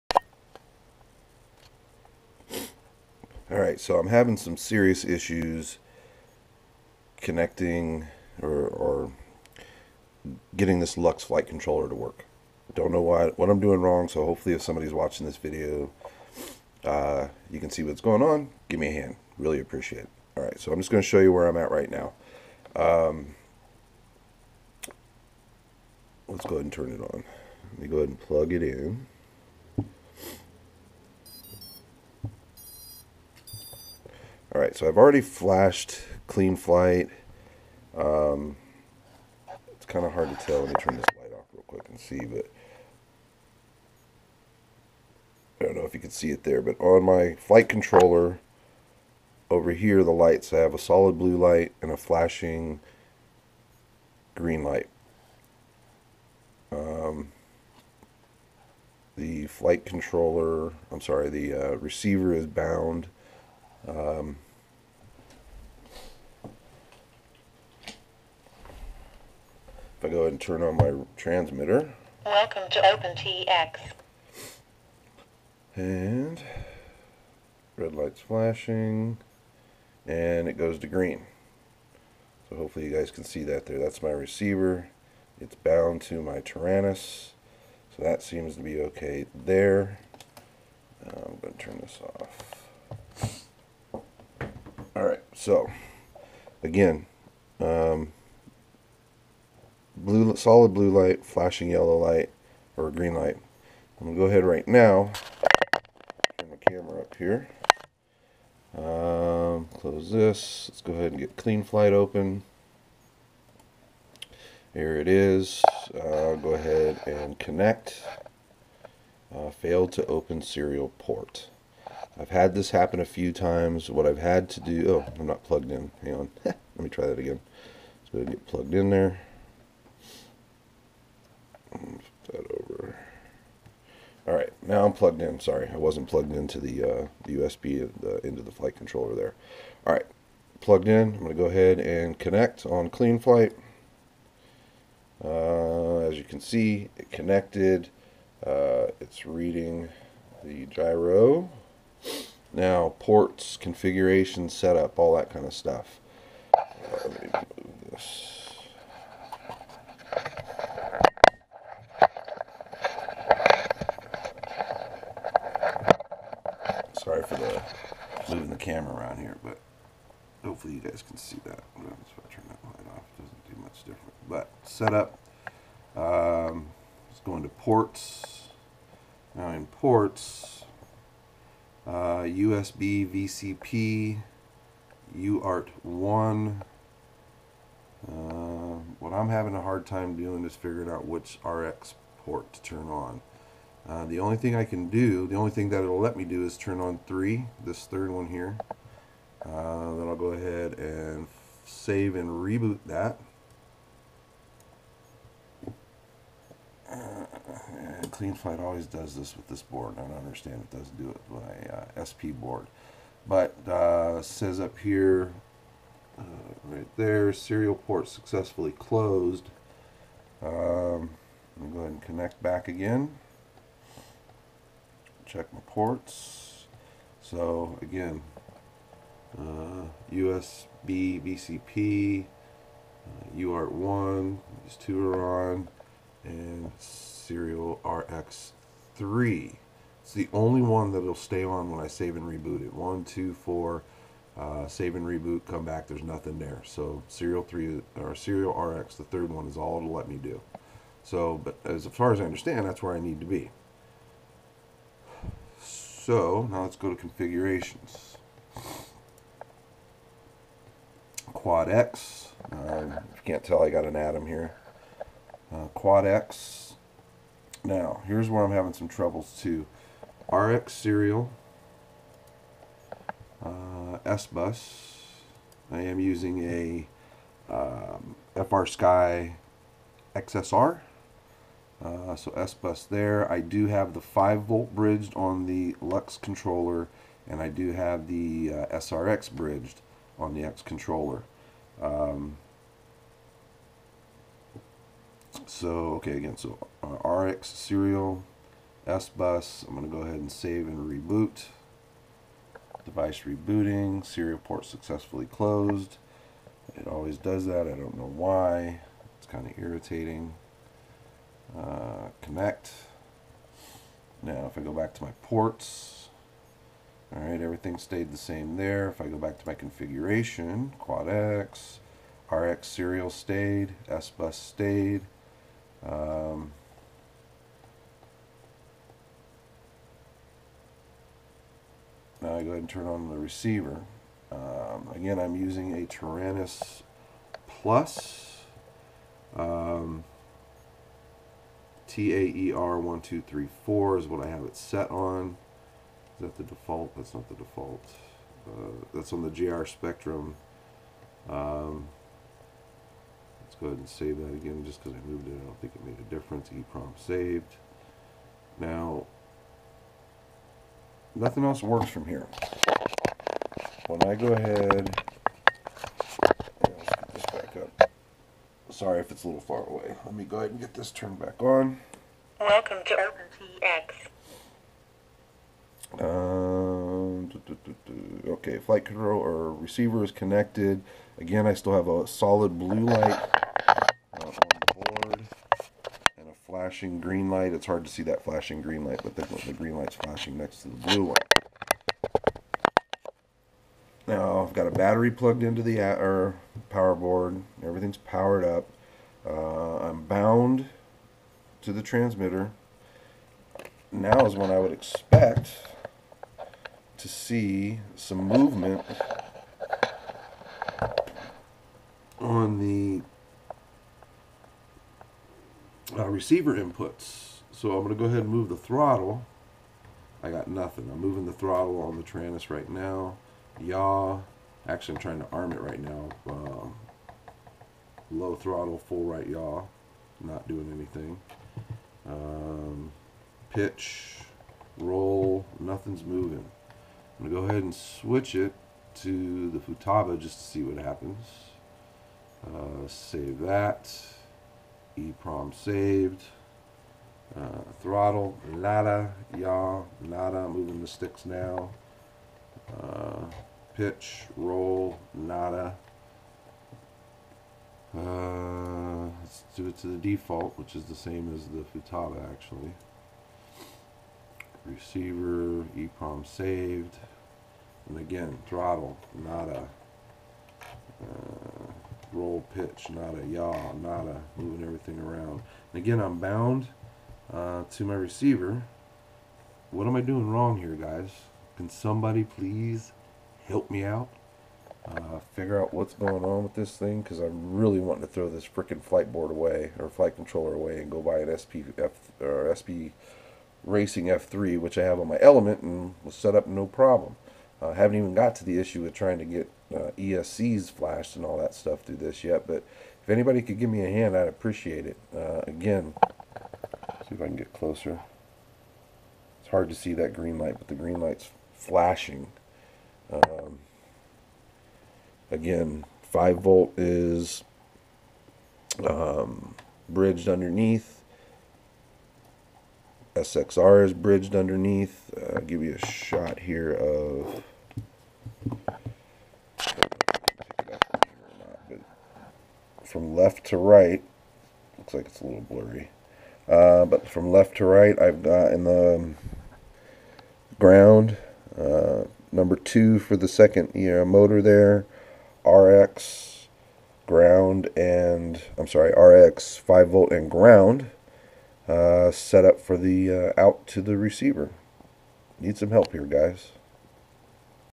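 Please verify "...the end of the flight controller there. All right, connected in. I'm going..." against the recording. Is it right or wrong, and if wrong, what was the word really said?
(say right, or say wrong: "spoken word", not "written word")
wrong: "plugged", not "connected".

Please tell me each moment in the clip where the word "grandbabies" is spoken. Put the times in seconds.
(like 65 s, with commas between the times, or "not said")
not said.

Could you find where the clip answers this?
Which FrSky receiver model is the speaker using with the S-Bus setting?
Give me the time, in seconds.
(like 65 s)
278 s.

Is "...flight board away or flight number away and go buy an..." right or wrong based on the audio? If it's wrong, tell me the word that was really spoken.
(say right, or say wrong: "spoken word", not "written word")
wrong: "controller", not "number".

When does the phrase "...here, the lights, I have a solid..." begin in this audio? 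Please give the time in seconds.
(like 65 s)
49 s.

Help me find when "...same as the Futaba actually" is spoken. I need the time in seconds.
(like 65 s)
460 s.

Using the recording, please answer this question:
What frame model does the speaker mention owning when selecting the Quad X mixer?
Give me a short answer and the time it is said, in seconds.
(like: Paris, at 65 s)
Atom, at 263 s.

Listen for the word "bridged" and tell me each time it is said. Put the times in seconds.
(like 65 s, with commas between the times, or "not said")
284 s, 289 s, 519 s, 523 s.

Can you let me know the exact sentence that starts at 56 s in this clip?
Um, the flight controller, I'm sorry, the uh, receiver is bound um, if I go ahead and turn on my transmitter.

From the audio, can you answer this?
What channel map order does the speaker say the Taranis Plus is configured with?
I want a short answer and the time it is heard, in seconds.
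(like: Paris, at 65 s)
TAER1234, at 341 s.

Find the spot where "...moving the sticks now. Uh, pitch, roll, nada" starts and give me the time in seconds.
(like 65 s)
450 s.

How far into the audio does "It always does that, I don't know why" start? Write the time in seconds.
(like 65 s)
306 s.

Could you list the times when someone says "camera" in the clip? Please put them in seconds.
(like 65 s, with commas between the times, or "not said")
106 s, 168 s.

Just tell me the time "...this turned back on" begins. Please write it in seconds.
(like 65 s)
370 s.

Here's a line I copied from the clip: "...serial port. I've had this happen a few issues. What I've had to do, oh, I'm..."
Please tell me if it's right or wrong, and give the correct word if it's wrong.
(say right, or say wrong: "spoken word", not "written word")
wrong: "times", not "issues".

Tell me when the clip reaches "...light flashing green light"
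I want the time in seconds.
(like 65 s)
382 s.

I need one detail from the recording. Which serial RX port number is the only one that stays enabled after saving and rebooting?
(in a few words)
3.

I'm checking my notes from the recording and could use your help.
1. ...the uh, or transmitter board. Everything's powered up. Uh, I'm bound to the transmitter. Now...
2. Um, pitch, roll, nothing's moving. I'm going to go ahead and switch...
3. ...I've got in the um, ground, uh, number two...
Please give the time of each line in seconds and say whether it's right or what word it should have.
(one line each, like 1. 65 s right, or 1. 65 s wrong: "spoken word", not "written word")
1. 395 s wrong: "power", not "transmitter"
2. 432 s right
3. 538 s right.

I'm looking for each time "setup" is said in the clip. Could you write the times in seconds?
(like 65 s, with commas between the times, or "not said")
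154 s, 174 s.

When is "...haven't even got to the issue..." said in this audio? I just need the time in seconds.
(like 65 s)
497 s.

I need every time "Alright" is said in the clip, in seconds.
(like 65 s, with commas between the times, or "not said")
3 s, 20 s.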